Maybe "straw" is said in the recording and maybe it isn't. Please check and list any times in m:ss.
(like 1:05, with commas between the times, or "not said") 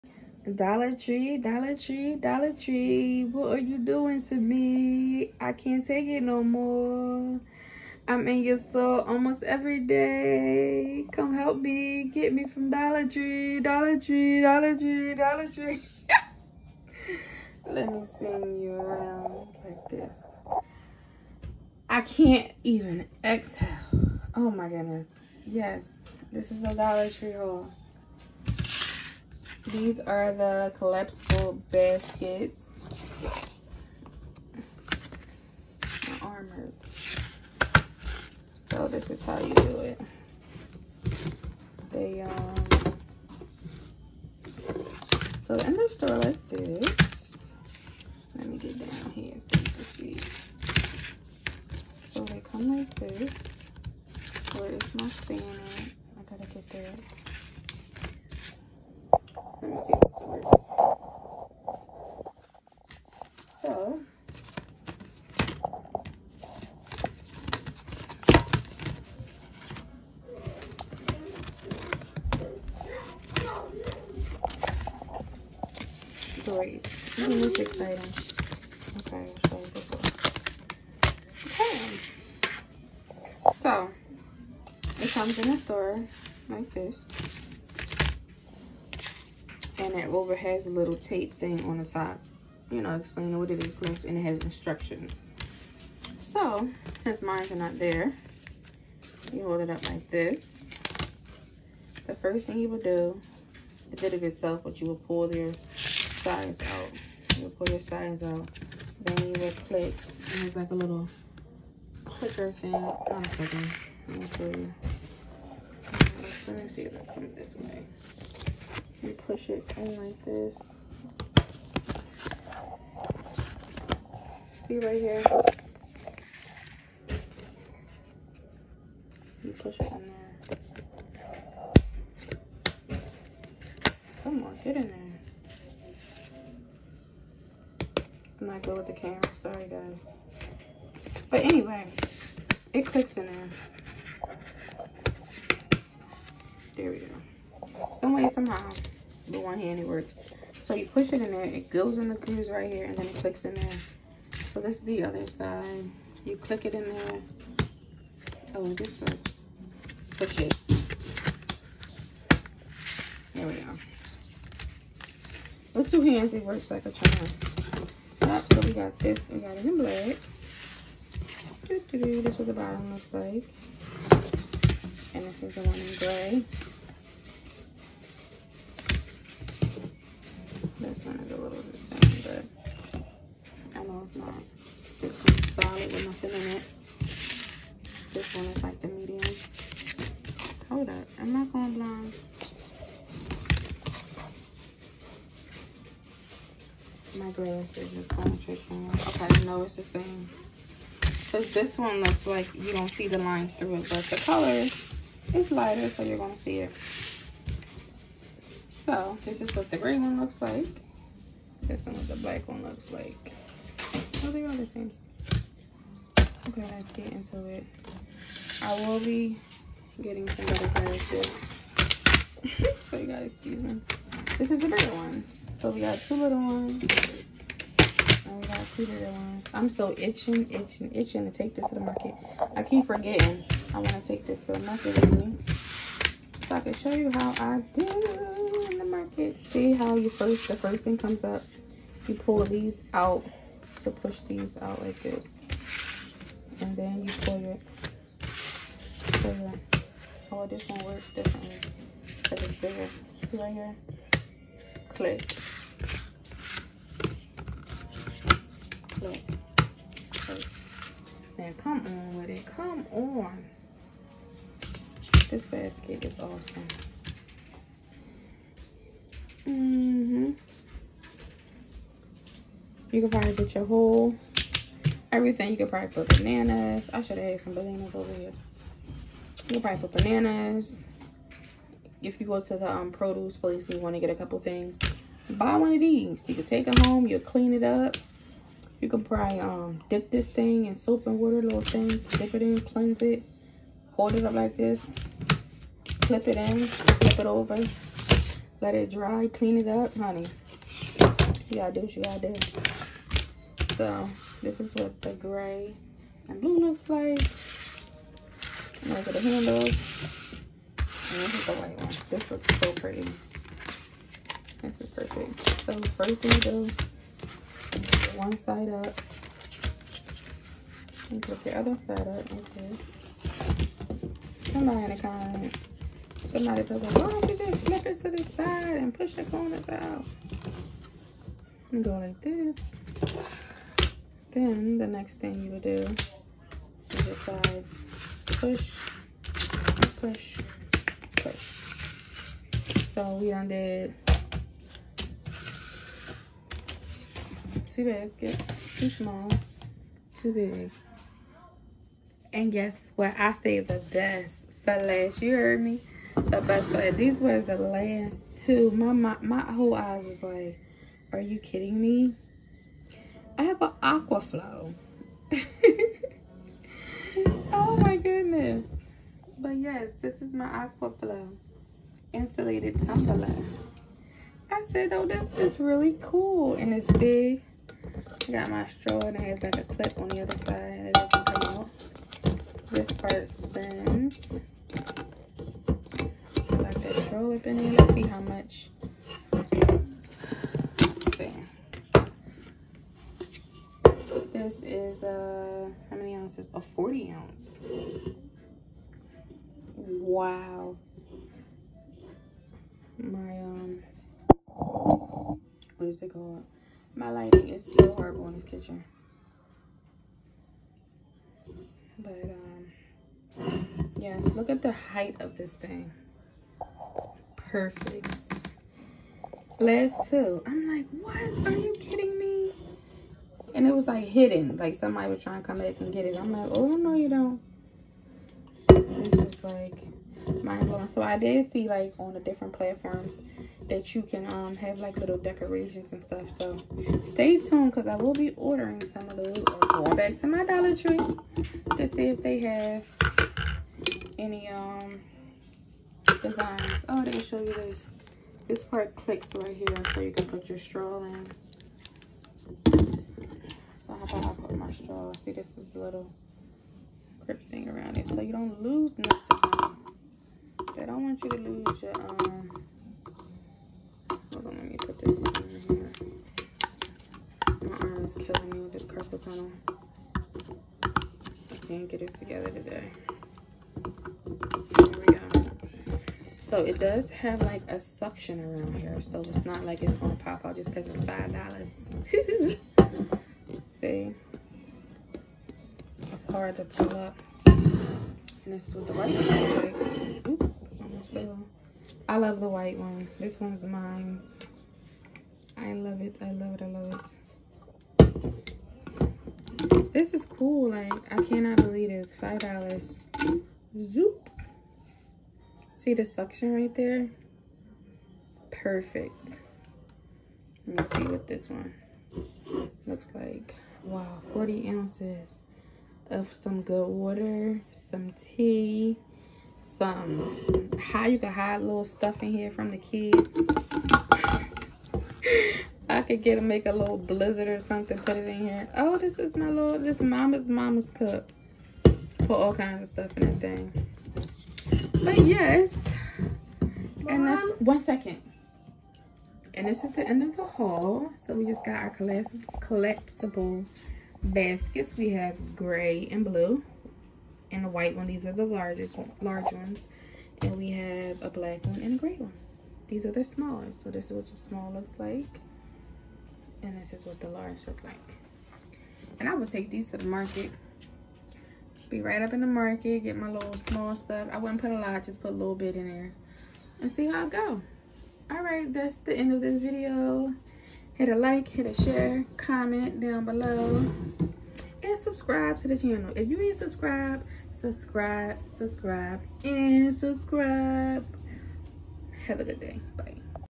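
6:18, 6:27, 7:30, 7:34.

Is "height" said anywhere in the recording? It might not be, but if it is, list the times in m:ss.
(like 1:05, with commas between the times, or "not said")
6:54.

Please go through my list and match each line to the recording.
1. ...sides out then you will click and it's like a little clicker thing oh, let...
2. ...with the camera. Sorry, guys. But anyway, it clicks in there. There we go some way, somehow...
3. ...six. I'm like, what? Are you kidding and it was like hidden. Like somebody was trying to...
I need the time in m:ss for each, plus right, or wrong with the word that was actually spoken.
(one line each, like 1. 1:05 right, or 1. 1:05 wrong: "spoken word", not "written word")
1. 1:47 right
2. 2:18 right
3. 7:00 wrong: "two", not "six".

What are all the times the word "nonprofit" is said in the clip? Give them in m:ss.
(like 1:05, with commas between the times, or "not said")
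not said.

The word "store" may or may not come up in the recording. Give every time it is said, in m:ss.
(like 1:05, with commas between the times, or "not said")
0:08, 0:45, 1:25.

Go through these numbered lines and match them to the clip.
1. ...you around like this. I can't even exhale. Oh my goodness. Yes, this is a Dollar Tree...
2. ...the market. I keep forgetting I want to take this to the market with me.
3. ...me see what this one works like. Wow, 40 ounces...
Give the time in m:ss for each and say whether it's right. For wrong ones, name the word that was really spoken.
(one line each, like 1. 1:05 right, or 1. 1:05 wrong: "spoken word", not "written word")
1. 0:18 right
2. 3:51 right
3. 8:30 wrong: "looks", not "works".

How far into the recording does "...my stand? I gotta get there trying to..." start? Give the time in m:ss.
0:54.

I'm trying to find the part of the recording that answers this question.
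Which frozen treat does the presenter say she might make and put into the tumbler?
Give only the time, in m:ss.
8:46.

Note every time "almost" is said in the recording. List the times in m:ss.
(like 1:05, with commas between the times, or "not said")
0:09.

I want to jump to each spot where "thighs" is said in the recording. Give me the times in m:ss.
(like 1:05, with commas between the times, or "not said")
5:37.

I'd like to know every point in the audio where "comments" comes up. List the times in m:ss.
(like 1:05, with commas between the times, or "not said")
5:25, 9:32.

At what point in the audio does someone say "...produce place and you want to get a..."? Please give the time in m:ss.
4:42.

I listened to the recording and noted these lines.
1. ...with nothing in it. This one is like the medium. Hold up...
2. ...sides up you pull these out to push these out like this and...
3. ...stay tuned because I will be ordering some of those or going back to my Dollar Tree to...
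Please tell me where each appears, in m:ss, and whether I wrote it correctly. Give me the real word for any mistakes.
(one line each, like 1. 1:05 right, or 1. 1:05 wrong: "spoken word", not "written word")
1. 3:05 right
2. 4:00 wrong: "comes", not "sides"
3. 7:17 right.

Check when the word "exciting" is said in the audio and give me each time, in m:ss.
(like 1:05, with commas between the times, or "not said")
1:17.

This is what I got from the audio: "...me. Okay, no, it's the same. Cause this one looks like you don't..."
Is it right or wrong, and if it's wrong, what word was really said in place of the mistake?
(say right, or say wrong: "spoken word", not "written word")
right.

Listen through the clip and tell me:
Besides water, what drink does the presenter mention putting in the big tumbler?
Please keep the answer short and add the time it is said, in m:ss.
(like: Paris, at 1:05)
Tea, at 8:37.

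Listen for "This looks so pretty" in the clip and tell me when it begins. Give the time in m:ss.
5:12.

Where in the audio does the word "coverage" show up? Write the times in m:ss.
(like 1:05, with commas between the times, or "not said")
not said.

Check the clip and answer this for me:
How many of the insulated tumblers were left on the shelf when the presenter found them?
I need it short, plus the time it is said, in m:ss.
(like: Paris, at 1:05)
2, at 5:56.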